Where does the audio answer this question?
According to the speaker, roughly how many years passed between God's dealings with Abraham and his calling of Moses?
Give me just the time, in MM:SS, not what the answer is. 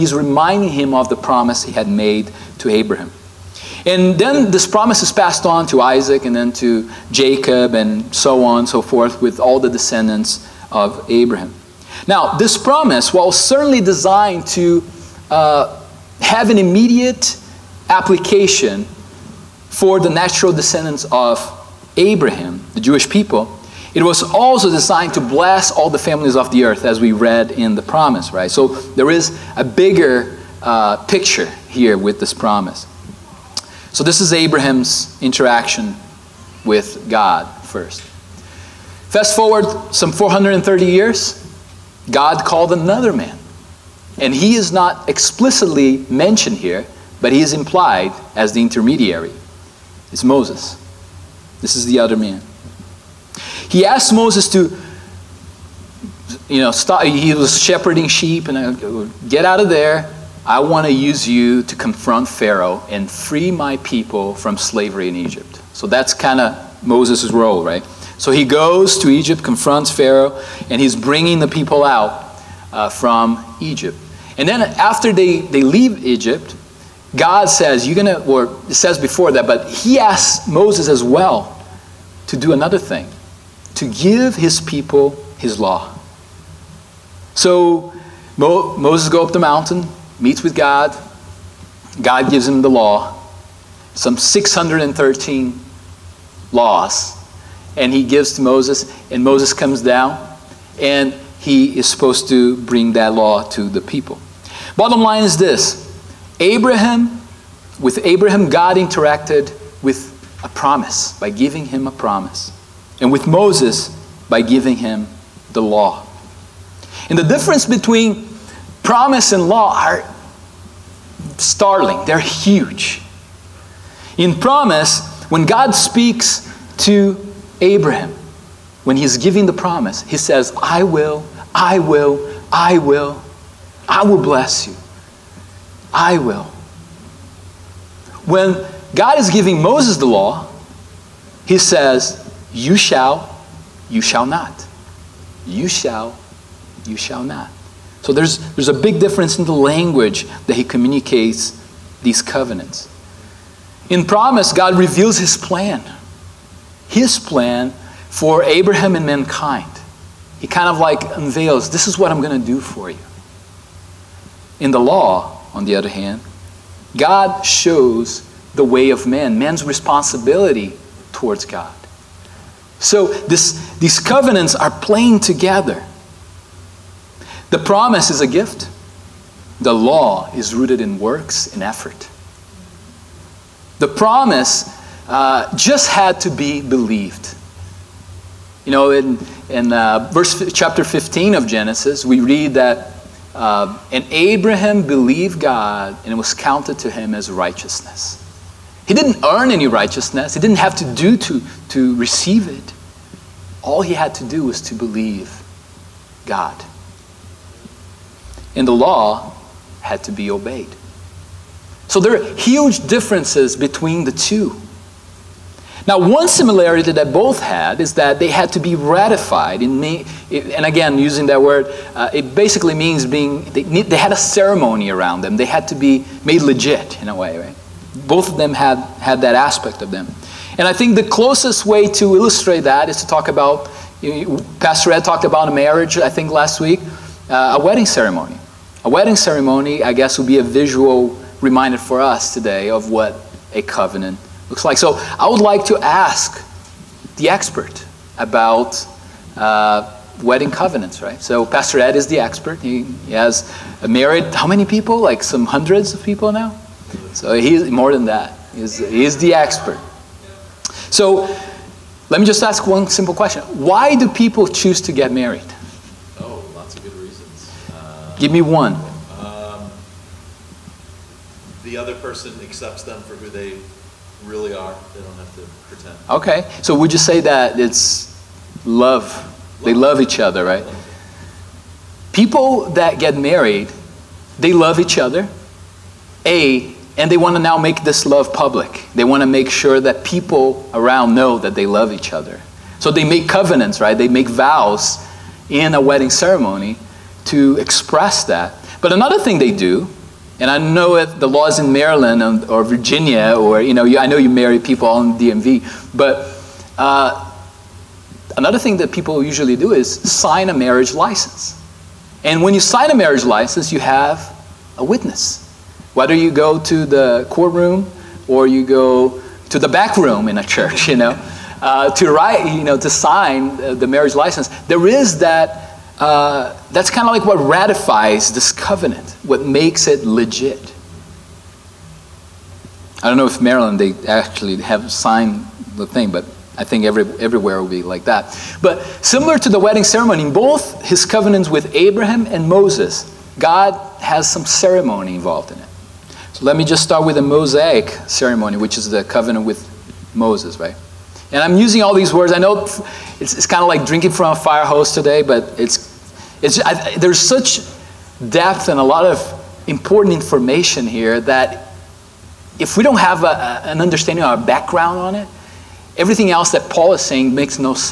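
00:40.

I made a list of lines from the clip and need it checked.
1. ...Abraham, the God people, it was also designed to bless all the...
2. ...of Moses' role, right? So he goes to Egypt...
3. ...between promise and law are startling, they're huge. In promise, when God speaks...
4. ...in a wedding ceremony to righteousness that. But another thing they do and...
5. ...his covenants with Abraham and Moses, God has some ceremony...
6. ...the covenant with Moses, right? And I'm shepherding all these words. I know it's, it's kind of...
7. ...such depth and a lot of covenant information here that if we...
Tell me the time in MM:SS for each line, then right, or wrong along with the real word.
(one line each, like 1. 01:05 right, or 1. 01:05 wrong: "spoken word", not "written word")
1. 00:21 wrong: "Jewish", not "God"
2. 01:06 right
3. 01:57 right
4. 04:55 wrong: "express", not "righteousness"
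5. 05:40 right
6. 05:48 wrong: "using", not "shepherding"
7. 05:57 wrong: "important", not "covenant".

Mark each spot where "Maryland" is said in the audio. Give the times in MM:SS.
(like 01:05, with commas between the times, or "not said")
05:01, 05:33.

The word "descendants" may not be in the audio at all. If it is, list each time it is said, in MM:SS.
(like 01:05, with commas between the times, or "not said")
00:09, 00:20.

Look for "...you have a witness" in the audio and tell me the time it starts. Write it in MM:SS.
05:13.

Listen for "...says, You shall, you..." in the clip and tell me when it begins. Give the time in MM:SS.
02:21.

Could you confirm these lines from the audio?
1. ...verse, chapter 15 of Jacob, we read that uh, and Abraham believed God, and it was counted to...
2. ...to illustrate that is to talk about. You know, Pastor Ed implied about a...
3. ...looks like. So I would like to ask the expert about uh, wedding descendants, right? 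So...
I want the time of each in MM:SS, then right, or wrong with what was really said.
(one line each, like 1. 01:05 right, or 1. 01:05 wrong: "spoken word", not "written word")
1. 03:10 wrong: "Genesis", not "Jacob"
2. 03:51 wrong: "talked", not "implied"
3. 04:04 wrong: "covenants", not "descendants".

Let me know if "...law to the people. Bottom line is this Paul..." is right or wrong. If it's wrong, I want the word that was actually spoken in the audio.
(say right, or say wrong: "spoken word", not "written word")
wrong: "Abraham", not "Paul".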